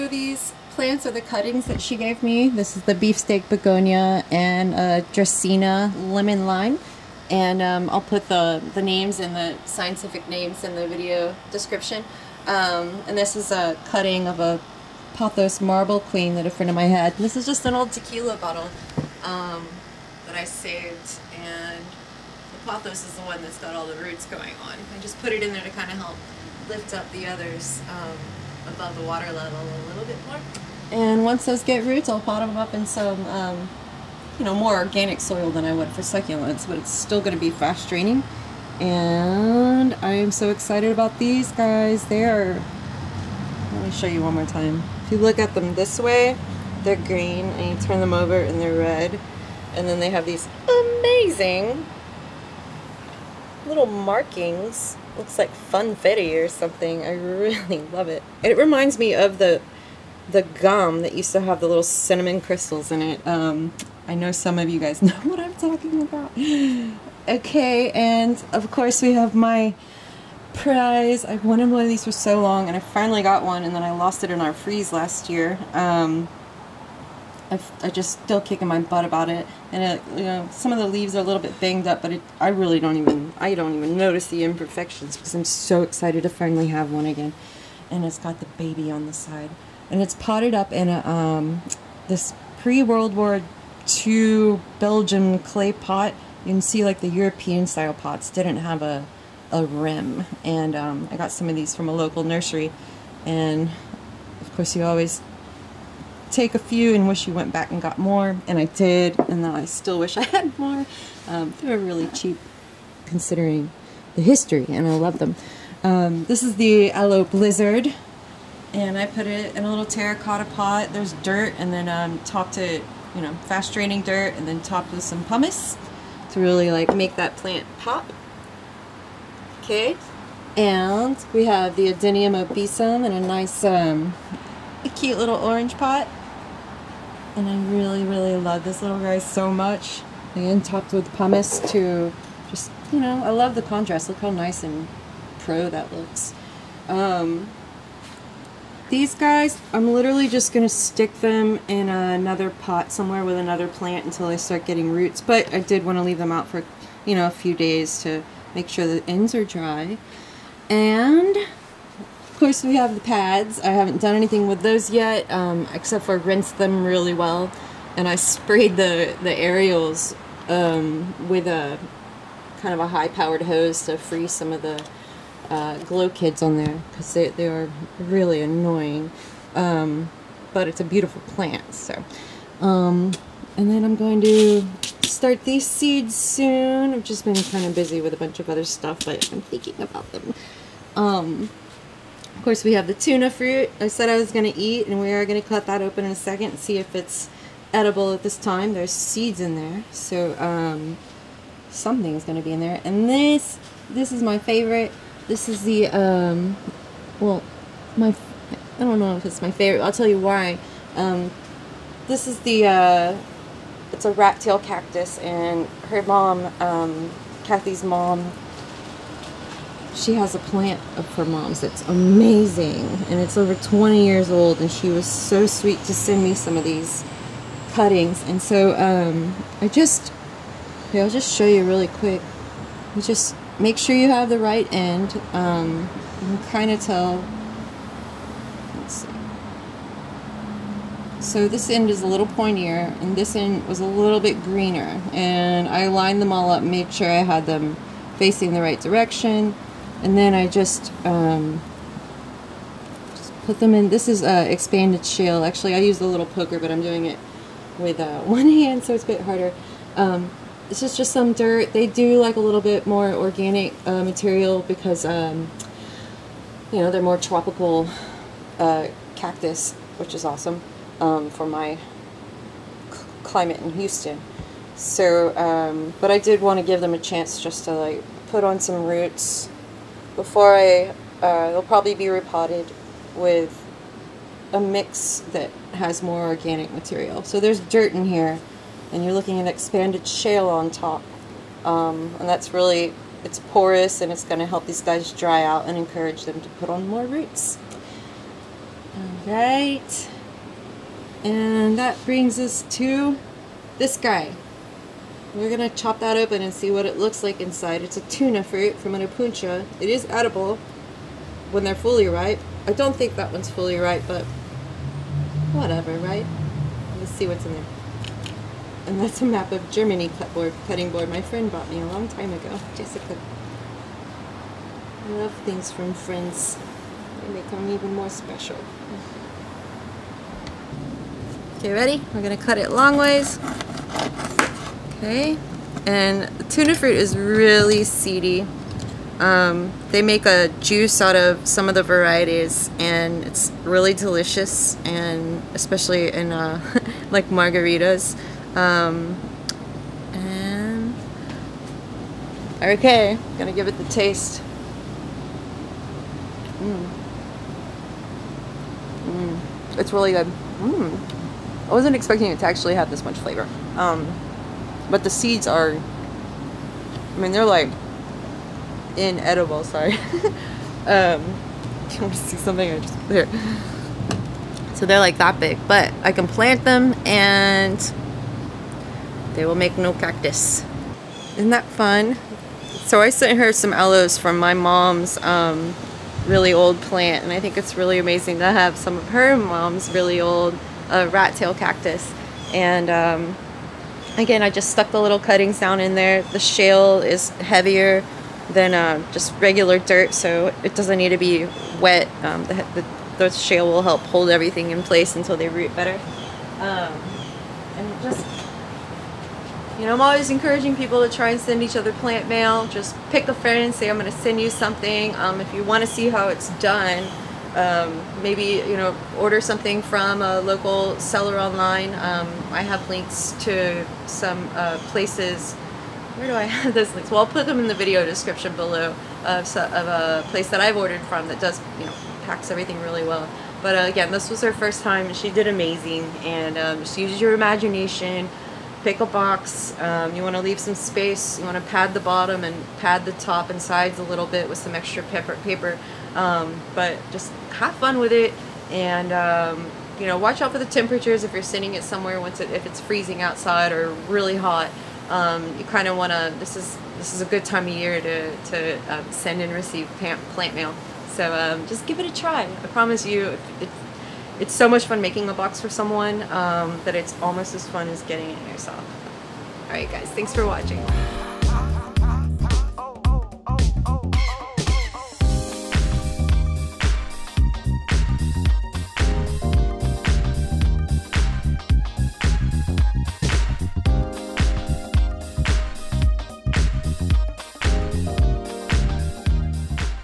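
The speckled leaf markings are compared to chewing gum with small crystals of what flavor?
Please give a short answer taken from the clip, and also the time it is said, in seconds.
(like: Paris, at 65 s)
Cinnamon, at 61 s.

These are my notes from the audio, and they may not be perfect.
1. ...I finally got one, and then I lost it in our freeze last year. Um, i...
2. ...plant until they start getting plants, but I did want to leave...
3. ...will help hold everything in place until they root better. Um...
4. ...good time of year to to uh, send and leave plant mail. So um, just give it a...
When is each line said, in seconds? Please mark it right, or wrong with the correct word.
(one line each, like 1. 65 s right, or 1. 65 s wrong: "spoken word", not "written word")
1. 72 s right
2. 153 s wrong: "roots", not "plants"
3. 403 s right
4. 457 s wrong: "receive", not "leave".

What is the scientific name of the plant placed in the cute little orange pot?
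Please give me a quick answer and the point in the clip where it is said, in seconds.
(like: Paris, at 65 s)
Adenium obesum, at 131 s.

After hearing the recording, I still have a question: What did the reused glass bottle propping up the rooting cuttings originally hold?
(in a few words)
Tequila.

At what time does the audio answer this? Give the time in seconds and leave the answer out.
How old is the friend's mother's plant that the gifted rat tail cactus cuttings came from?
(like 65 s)
223 s.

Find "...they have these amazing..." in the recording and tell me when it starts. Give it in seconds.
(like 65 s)
49 s.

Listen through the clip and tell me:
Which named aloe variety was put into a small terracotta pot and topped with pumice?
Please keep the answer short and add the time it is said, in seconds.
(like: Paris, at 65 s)
Aloe Blizzard, at 116 s.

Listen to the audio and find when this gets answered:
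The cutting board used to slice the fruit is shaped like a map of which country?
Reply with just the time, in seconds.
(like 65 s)
319 s.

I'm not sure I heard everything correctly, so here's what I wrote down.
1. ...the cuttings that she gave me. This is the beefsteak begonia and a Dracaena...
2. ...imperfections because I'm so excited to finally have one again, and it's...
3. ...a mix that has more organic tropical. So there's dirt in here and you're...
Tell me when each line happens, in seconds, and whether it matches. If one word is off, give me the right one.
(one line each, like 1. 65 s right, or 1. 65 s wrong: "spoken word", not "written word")
1. 1 s right
2. 84 s right
3. 284 s wrong: "material", not "tropical".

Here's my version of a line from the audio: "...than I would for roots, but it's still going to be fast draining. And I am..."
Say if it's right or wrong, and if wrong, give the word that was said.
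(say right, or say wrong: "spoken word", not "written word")
wrong: "succulents", not "roots".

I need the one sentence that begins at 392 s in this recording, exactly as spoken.
And um, again, I just stuck the little cuttings down in there.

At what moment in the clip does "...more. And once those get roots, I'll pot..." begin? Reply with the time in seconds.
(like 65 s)
30 s.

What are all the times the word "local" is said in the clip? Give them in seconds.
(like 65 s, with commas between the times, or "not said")
101 s, 420 s.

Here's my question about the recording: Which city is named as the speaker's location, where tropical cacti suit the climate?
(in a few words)
Houston.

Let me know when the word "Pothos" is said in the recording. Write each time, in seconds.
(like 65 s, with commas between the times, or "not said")
15 s, 22 s.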